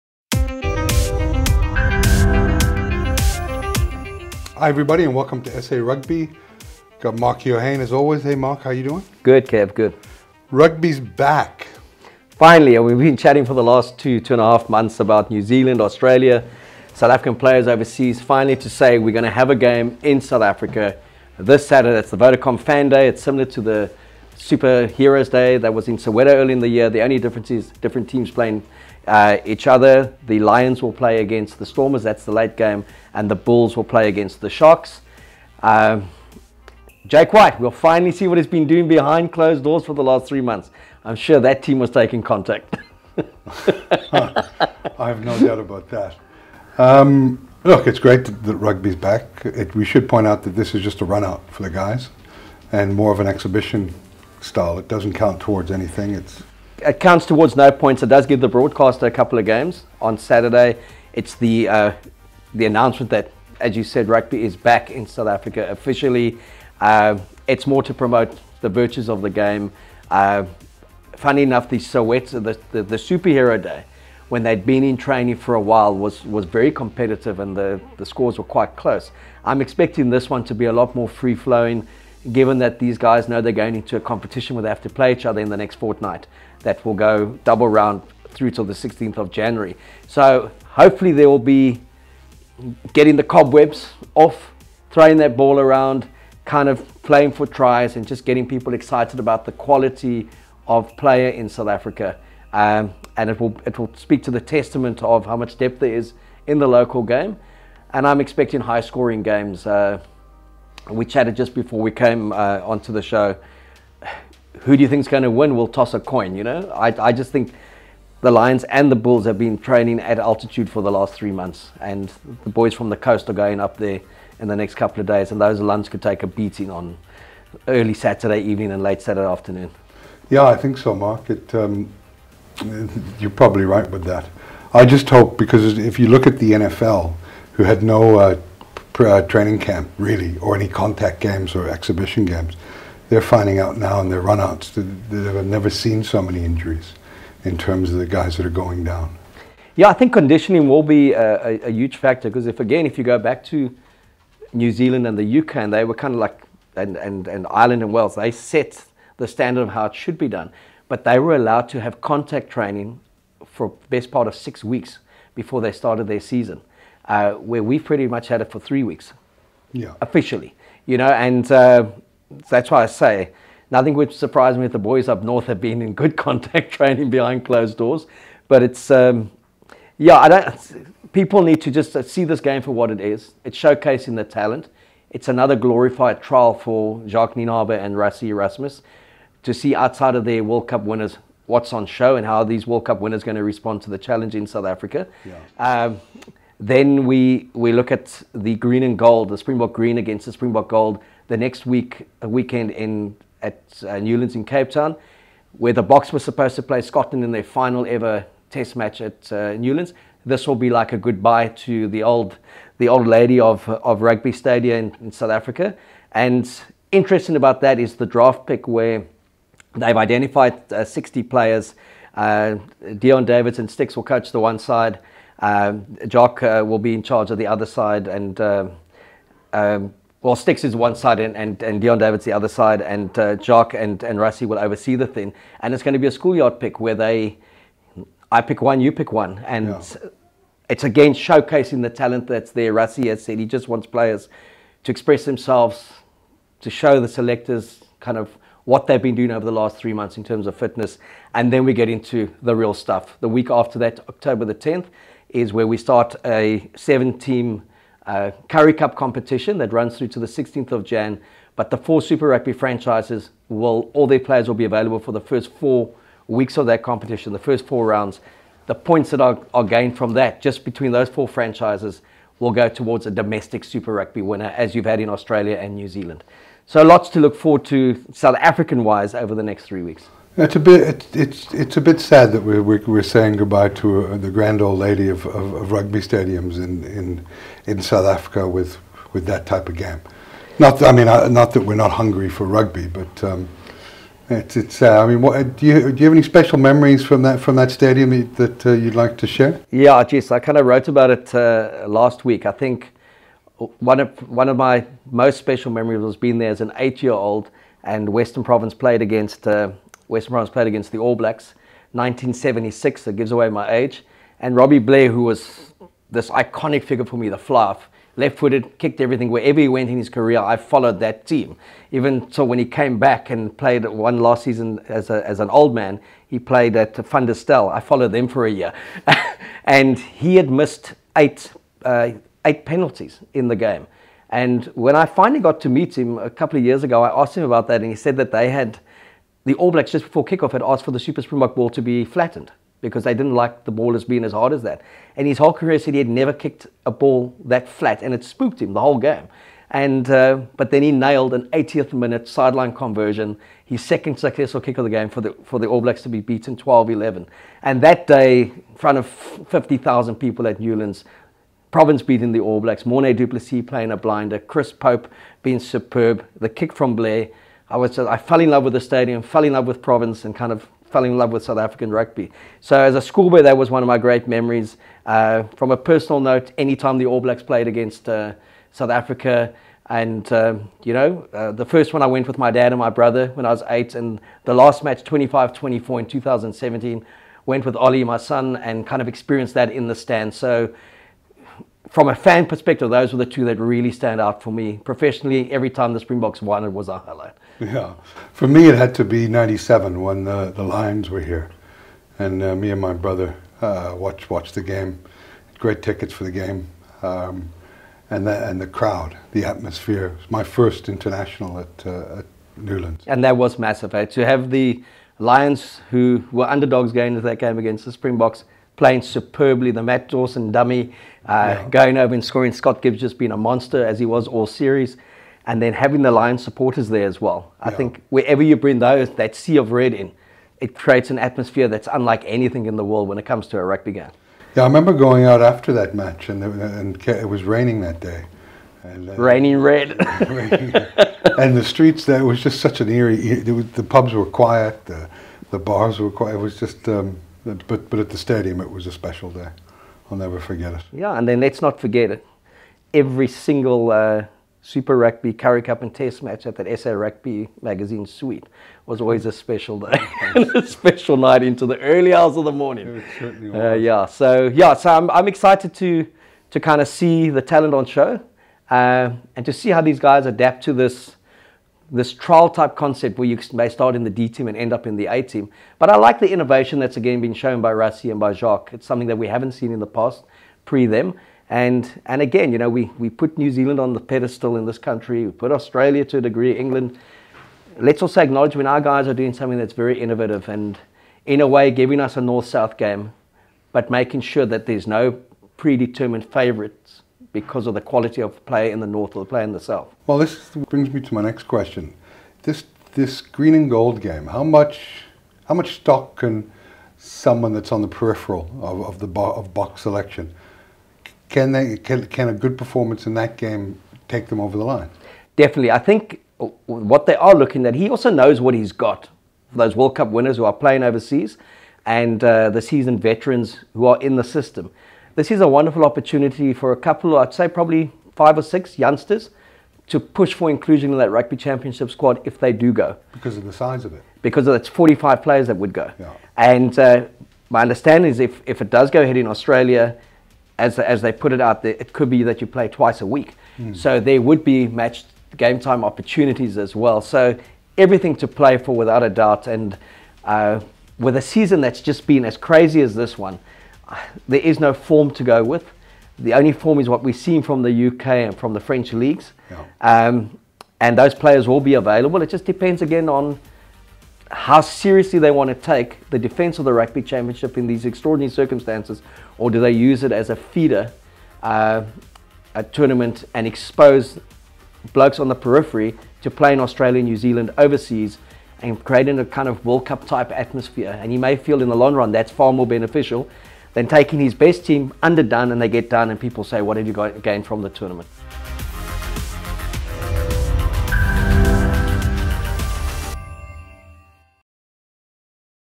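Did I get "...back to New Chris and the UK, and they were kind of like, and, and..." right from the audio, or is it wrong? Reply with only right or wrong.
wrong.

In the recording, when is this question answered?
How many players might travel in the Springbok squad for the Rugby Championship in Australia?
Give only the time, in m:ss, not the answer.
8:54.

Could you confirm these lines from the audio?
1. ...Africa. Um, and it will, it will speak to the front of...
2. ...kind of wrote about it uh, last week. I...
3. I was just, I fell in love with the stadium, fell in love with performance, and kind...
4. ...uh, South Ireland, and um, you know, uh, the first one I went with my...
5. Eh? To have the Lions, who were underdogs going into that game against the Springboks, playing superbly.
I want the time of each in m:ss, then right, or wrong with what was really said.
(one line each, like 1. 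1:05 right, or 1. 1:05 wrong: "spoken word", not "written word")
1. 1:41 wrong: "testament", not "front"
2. 5:00 right
3. 6:07 wrong: "province", not "performance"
4. 6:18 wrong: "Africa", not "Ireland"
5. 6:53 right.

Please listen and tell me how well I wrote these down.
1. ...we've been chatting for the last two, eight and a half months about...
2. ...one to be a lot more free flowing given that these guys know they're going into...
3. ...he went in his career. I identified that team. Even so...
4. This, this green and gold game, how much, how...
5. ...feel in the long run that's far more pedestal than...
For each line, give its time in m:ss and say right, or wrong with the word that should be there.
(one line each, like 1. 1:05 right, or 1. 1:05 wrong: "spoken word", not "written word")
1. 0:12 wrong: "two", not "eight"
2. 1:20 right
3. 5:19 wrong: "followed", not "identified"
4. 8:22 right
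5. 9:41 wrong: "beneficial", not "pedestal".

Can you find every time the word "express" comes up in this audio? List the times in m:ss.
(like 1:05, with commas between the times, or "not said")
4:04.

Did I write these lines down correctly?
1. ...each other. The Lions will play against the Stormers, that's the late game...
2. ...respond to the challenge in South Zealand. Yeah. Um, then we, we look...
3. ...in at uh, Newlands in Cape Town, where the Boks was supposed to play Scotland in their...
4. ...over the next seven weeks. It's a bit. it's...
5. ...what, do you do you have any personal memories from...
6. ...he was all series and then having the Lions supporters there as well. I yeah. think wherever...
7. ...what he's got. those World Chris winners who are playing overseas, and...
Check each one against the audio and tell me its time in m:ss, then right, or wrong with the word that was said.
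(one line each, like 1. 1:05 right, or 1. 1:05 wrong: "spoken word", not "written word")
1. 0:29 right
2. 3:13 wrong: "Africa", not "Zealand"
3. 3:22 right
4. 4:39 wrong: "three", not "seven"
5. 4:55 wrong: "special", not "personal"
6. 7:03 right
7. 8:38 wrong: "Cup", not "Chris".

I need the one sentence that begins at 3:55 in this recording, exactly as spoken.
And it's going to be a schoolyard pick where they, I pick one, you pick one.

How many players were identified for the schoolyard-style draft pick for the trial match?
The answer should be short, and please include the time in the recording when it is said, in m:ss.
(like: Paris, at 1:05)
60, at 3:40.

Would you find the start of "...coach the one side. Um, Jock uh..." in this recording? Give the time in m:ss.
3:44.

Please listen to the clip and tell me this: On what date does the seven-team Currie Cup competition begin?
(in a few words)
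October 10.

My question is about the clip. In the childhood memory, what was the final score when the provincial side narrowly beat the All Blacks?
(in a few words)
12-11.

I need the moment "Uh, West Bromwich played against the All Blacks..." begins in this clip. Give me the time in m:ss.
5:09.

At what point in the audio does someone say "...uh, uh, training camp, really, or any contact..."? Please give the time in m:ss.
2:18.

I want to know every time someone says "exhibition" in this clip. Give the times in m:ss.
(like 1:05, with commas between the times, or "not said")
0:53, 2:21.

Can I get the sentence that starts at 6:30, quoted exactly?
So from a fan perspective, those were the two that really stand out for me.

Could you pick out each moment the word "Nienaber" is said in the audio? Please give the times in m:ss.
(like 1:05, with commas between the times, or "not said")
3:07.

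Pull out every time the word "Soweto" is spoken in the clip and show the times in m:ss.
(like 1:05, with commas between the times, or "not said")
0:25, 1:11.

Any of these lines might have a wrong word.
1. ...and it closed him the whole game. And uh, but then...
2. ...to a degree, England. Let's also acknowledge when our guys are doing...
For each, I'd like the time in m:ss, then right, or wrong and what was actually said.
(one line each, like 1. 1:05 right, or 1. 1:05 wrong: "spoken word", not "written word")
1. 5:48 wrong: "spooked", not "closed"
2. 8:06 right.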